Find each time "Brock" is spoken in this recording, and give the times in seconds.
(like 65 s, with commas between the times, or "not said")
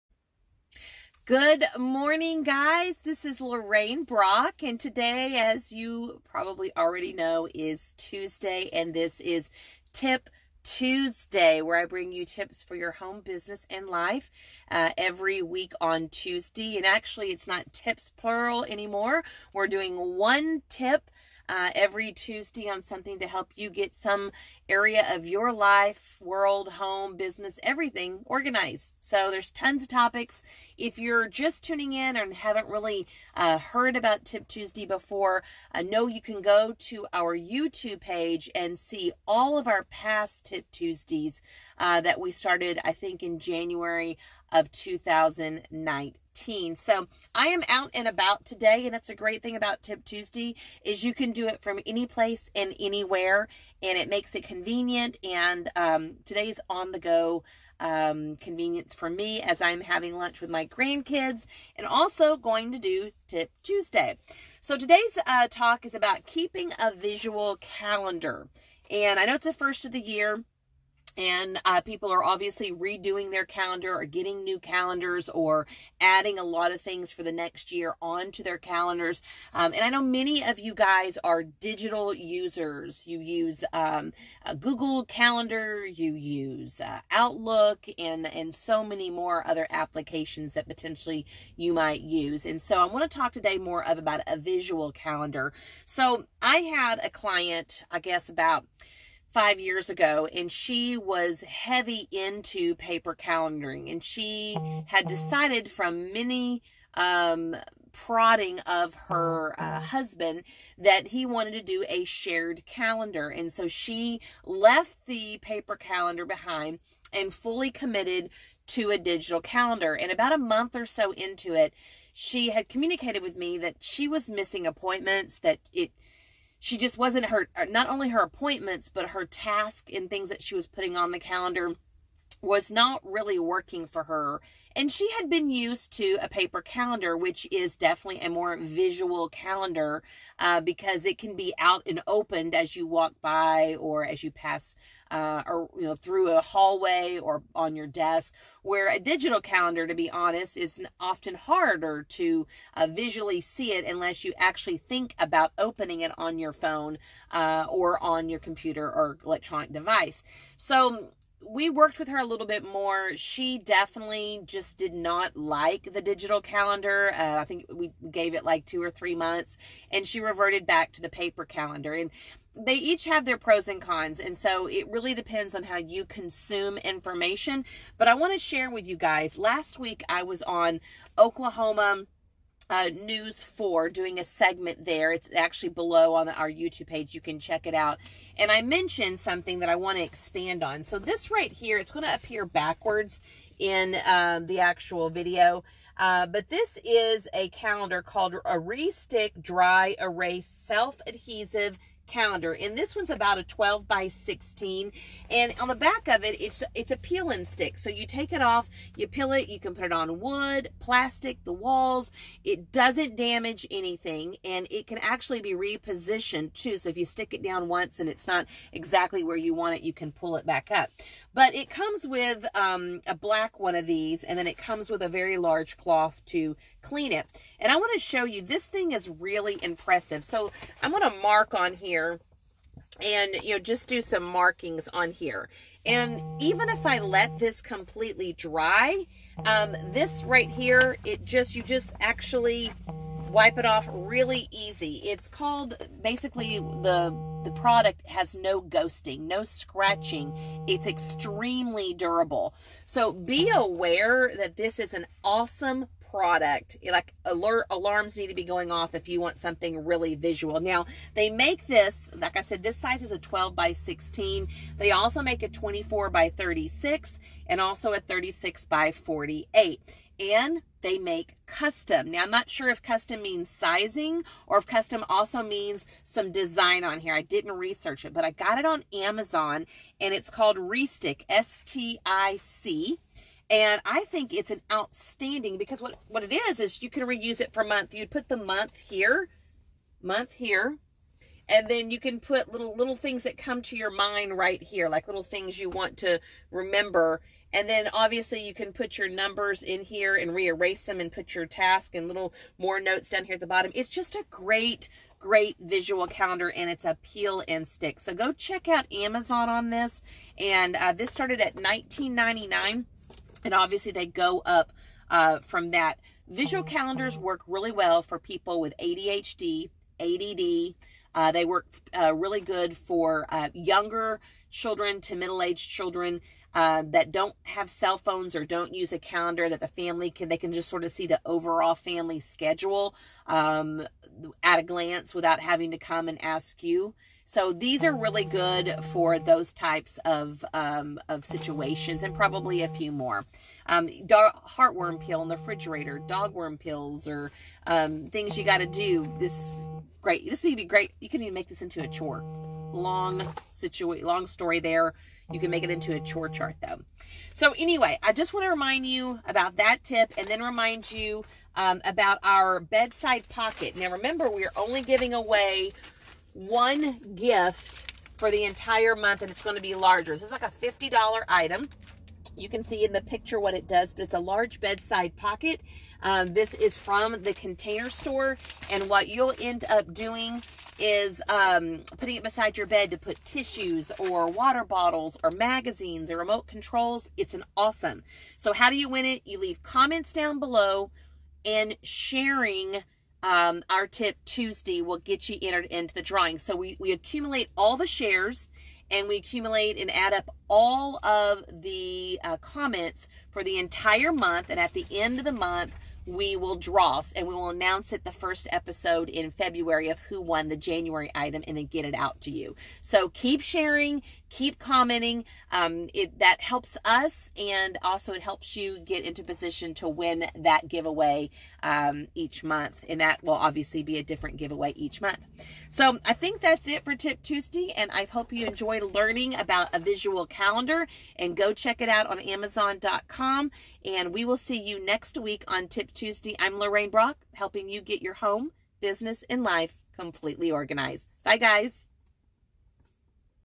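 4 s, 436 s.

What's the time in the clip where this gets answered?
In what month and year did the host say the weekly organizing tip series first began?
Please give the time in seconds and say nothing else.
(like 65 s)
43 s.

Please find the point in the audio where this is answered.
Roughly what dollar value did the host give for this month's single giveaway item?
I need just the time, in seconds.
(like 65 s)
370 s.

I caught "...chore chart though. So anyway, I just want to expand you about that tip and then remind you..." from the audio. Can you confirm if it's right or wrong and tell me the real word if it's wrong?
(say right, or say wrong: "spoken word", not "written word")
wrong: "remind", not "expand".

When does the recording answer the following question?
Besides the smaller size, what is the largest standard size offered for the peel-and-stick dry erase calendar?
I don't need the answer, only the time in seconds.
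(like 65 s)
267 s.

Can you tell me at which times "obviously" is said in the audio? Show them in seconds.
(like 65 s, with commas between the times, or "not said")
72 s, 297 s, 313 s, 423 s.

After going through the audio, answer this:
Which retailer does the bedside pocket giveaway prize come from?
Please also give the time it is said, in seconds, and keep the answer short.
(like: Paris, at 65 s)
The Container Store, at 377 s.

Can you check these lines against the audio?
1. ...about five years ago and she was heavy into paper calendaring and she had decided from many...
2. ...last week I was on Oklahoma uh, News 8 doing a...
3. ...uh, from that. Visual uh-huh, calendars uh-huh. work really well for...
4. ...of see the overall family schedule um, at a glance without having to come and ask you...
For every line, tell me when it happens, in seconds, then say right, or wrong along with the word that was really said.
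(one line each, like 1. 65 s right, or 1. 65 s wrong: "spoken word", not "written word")
1. 98 s right
2. 179 s wrong: "4", not "8"
3. 315 s right
4. 330 s right.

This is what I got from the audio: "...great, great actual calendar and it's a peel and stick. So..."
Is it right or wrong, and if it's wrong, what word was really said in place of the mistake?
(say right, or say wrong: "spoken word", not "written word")
wrong: "visual", not "actual".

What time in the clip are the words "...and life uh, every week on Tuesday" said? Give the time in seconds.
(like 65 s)
13 s.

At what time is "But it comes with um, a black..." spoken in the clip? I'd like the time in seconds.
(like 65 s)
221 s.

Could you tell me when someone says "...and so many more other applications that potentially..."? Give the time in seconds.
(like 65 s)
88 s.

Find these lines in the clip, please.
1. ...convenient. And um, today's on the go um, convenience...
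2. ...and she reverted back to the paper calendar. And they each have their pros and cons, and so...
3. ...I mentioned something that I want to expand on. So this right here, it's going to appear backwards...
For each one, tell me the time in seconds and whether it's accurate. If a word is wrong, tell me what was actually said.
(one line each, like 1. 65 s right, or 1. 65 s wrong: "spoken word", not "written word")
1. 54 s right
2. 169 s right
3. 188 s right.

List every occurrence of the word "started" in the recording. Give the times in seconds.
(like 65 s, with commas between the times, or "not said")
42 s, 311 s.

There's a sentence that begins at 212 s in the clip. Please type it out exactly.
It doesn't damage anything and it can actually be repositioned too.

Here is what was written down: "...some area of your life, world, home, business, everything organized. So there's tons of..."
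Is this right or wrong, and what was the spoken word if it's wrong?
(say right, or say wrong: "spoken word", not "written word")
right.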